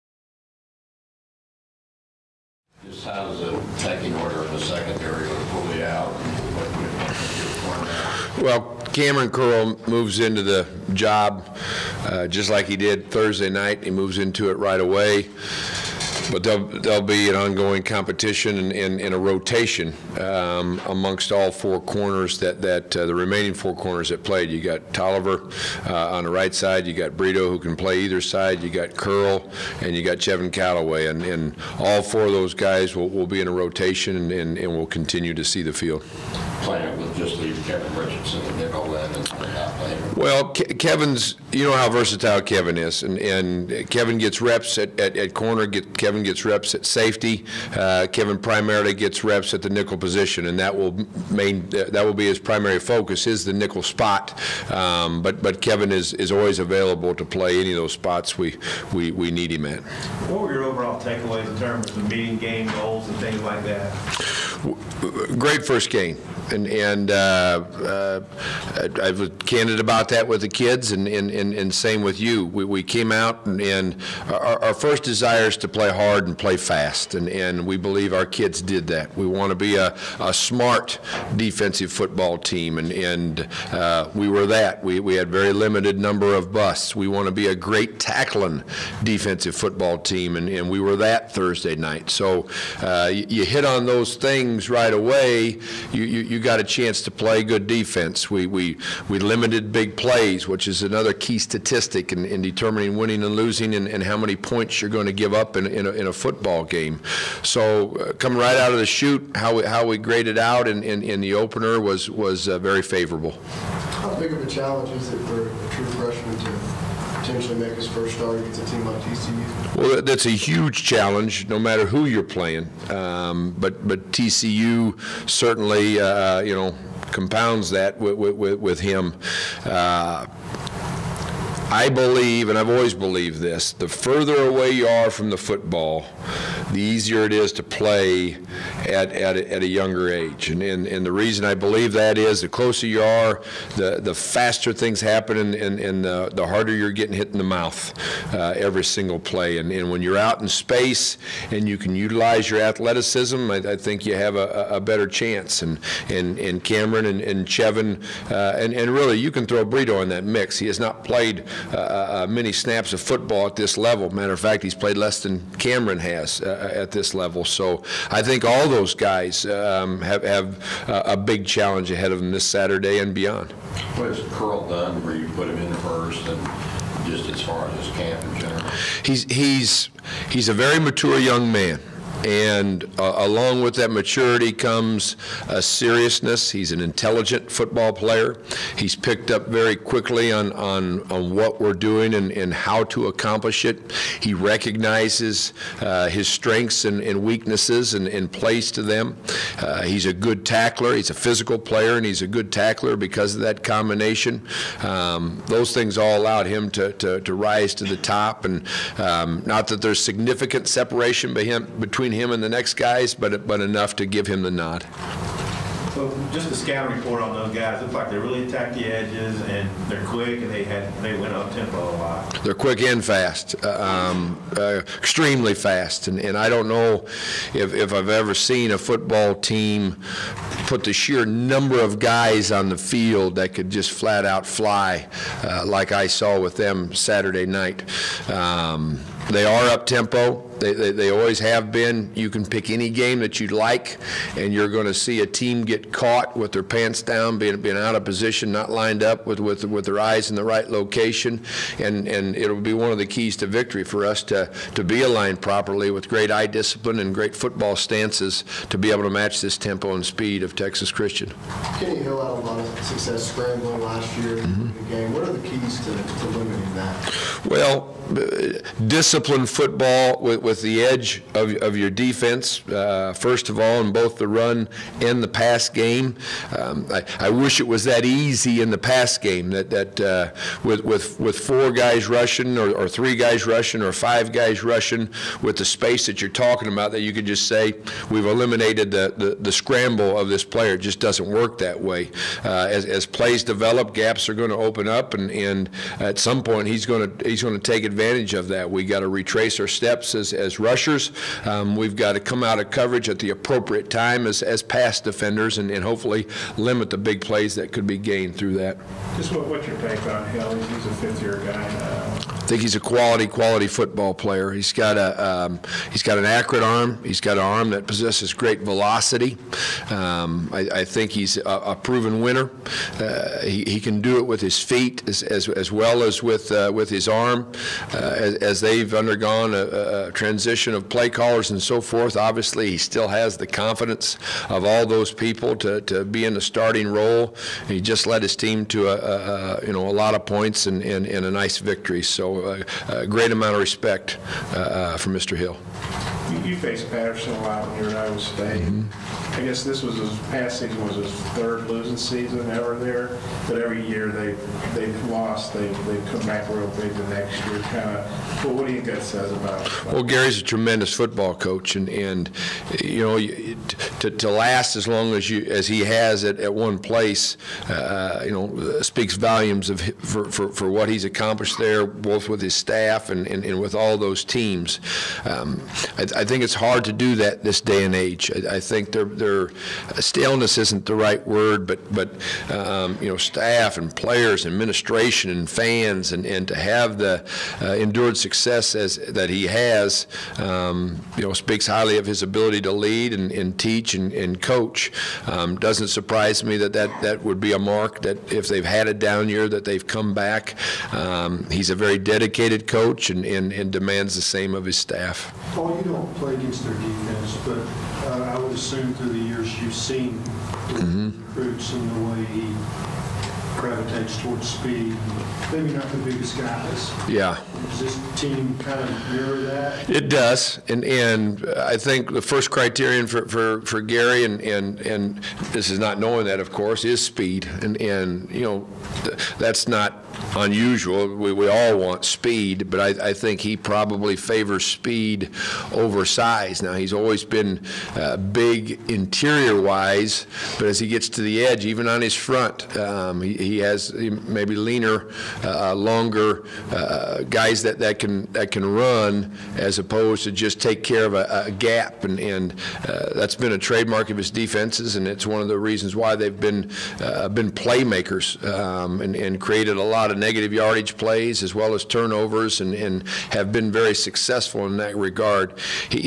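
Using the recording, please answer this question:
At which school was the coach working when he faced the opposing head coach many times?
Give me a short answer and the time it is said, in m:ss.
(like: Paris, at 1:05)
Iowa State, at 5:48.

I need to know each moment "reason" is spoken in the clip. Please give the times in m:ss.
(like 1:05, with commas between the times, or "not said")
2:21, 7:35.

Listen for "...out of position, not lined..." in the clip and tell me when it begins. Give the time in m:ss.
4:07.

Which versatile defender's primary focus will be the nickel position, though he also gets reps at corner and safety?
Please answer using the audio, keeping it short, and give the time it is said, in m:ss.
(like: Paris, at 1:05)
Kevin Richardson, at 0:37.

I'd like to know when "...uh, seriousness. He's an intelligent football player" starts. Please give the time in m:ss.
3:05.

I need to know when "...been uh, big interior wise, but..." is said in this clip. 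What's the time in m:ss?
7:17.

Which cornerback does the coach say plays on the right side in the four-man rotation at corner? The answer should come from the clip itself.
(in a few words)
Toliver.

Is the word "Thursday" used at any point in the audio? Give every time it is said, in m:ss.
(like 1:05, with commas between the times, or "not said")
0:13, 1:31.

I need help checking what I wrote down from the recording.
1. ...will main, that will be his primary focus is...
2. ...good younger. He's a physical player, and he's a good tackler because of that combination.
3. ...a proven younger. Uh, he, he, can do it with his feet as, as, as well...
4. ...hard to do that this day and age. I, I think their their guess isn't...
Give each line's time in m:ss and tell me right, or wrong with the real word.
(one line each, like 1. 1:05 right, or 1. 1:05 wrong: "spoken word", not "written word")
1. 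0:50 right
2. 3:20 wrong: "tackler", not "younger"
3. 5:21 wrong: "winner", not "younger"
4. 6:16 wrong: "staleness", not "guess".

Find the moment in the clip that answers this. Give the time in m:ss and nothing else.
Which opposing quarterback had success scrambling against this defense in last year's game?
4:21.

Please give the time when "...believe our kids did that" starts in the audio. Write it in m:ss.
1:17.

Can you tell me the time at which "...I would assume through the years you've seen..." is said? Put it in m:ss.
6:48.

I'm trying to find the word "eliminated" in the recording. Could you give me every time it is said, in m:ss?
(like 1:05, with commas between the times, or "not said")
4:48.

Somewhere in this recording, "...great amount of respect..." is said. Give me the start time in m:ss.
5:43.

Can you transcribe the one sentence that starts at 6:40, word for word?
Um, he's a very dedicated coach and, and, and demands the same of his staff.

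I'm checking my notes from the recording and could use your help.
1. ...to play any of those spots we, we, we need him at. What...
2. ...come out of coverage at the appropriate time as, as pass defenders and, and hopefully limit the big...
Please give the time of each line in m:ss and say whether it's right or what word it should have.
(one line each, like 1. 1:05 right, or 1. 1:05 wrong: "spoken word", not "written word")
1. 0:57 right
2. 5:02 right.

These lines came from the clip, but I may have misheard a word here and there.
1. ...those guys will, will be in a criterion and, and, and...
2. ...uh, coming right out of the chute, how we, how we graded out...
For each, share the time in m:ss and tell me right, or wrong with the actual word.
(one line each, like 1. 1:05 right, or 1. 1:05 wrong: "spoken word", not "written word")
1. 0:32 wrong: "rotation", not "criterion"
2. 1:47 right.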